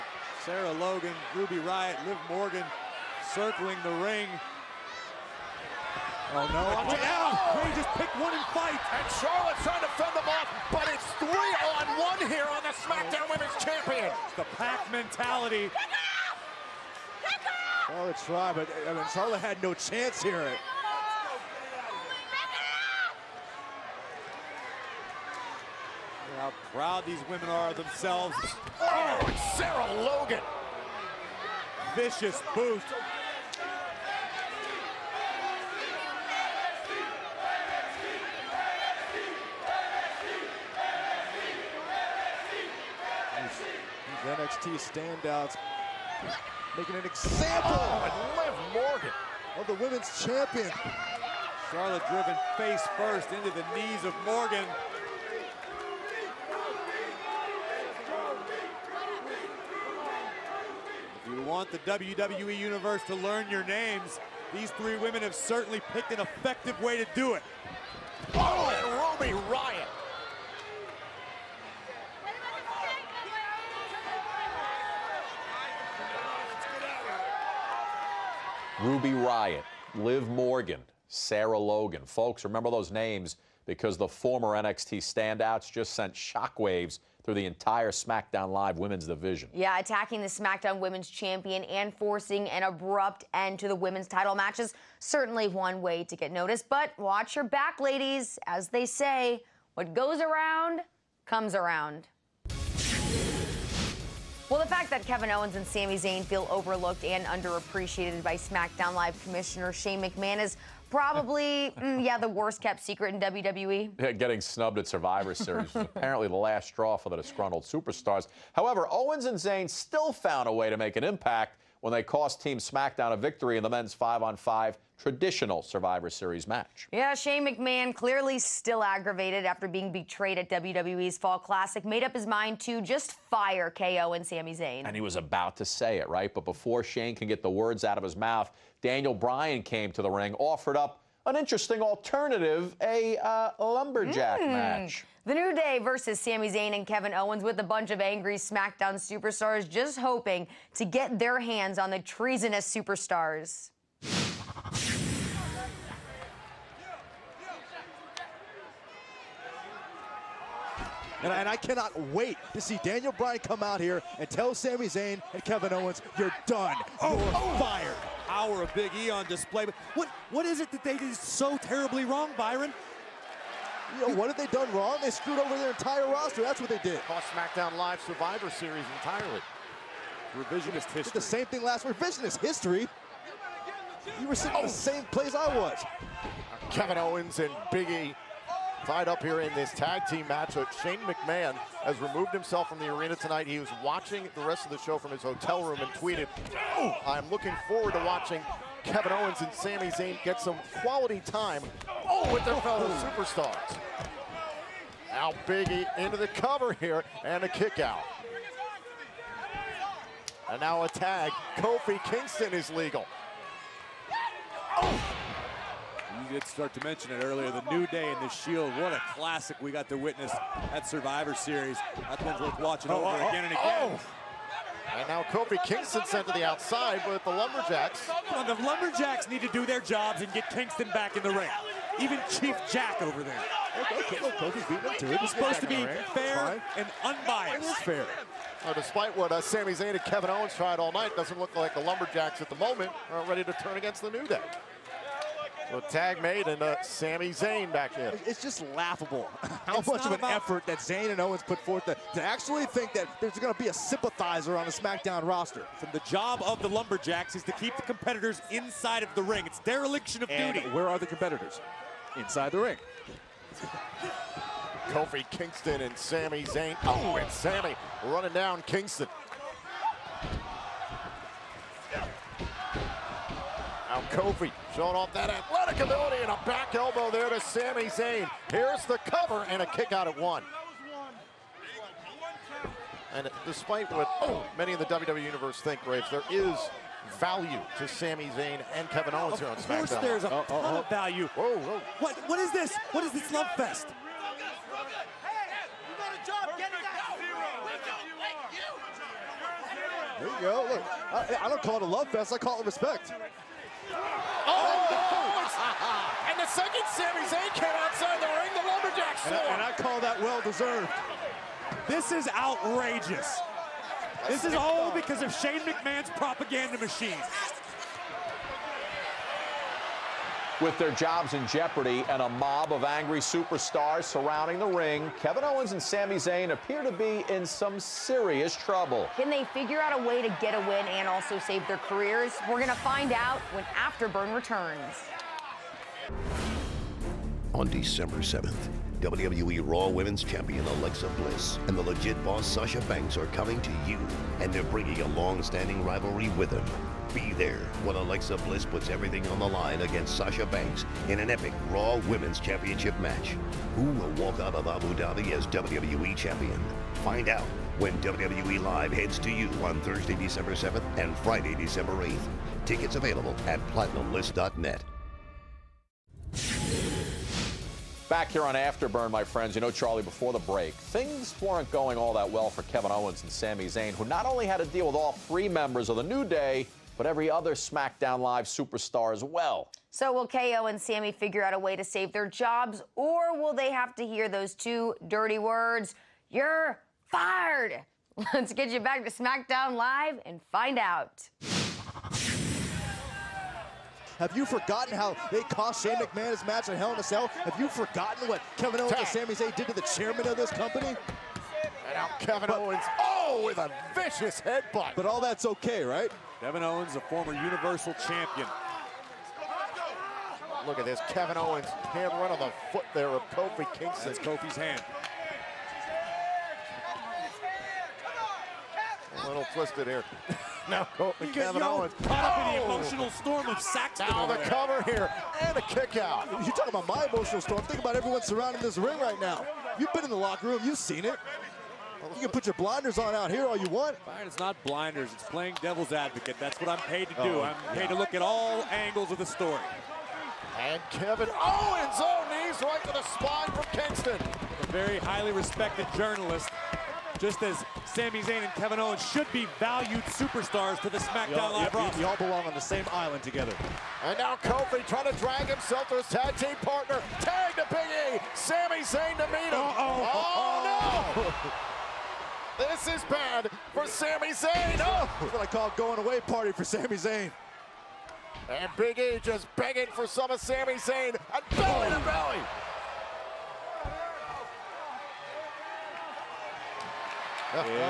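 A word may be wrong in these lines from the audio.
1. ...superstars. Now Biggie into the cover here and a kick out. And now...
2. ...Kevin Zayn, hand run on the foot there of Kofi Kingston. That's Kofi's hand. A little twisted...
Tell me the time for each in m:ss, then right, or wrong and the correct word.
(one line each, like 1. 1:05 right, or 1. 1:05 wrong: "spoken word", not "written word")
1. 3:22 right
2. 6:51 wrong: "Owens", not "Zayn".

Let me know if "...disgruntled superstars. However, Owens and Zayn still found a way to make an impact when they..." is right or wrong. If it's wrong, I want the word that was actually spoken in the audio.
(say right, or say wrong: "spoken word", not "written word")
right.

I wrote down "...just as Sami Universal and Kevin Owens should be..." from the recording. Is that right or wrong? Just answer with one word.
wrong.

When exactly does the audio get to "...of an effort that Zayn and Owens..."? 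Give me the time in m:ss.
4:10.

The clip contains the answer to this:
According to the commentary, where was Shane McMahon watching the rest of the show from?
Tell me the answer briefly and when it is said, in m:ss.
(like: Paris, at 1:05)
His hotel room, at 3:15.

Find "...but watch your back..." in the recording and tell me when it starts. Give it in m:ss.
1:36.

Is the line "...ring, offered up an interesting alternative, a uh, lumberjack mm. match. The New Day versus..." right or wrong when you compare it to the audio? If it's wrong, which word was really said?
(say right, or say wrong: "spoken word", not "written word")
right.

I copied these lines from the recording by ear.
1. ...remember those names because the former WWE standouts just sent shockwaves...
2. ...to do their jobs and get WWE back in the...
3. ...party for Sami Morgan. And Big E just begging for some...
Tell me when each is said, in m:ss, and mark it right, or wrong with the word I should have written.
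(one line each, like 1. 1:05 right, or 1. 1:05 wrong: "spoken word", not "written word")
1. 1:22 wrong: "NXT", not "WWE"
2. 3:49 wrong: "Kingston", not "WWE"
3. 7:46 wrong: "Zayn", not "Morgan".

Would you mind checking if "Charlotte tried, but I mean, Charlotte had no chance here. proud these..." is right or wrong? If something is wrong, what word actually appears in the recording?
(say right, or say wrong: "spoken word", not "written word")
right.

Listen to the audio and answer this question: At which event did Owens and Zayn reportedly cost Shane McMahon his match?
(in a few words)
Hell in a Cell.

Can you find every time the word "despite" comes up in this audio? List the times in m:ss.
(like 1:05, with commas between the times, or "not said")
3:58, 4:43.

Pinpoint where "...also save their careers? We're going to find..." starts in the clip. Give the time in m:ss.
5:31.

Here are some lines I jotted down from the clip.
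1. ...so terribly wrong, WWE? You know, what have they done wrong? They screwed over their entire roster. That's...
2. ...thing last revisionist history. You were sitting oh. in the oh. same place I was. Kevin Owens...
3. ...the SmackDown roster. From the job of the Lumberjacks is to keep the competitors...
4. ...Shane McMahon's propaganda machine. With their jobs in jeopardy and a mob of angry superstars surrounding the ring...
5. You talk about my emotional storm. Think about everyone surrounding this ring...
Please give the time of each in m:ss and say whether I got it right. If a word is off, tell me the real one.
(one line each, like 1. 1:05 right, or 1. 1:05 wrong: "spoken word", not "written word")
1. 2:51 wrong: "Byron", not "WWE"
2. 3:01 right
3. 4:14 right
4. 5:15 right
5. 7:06 right.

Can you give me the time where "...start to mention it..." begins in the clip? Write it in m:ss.
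3:36.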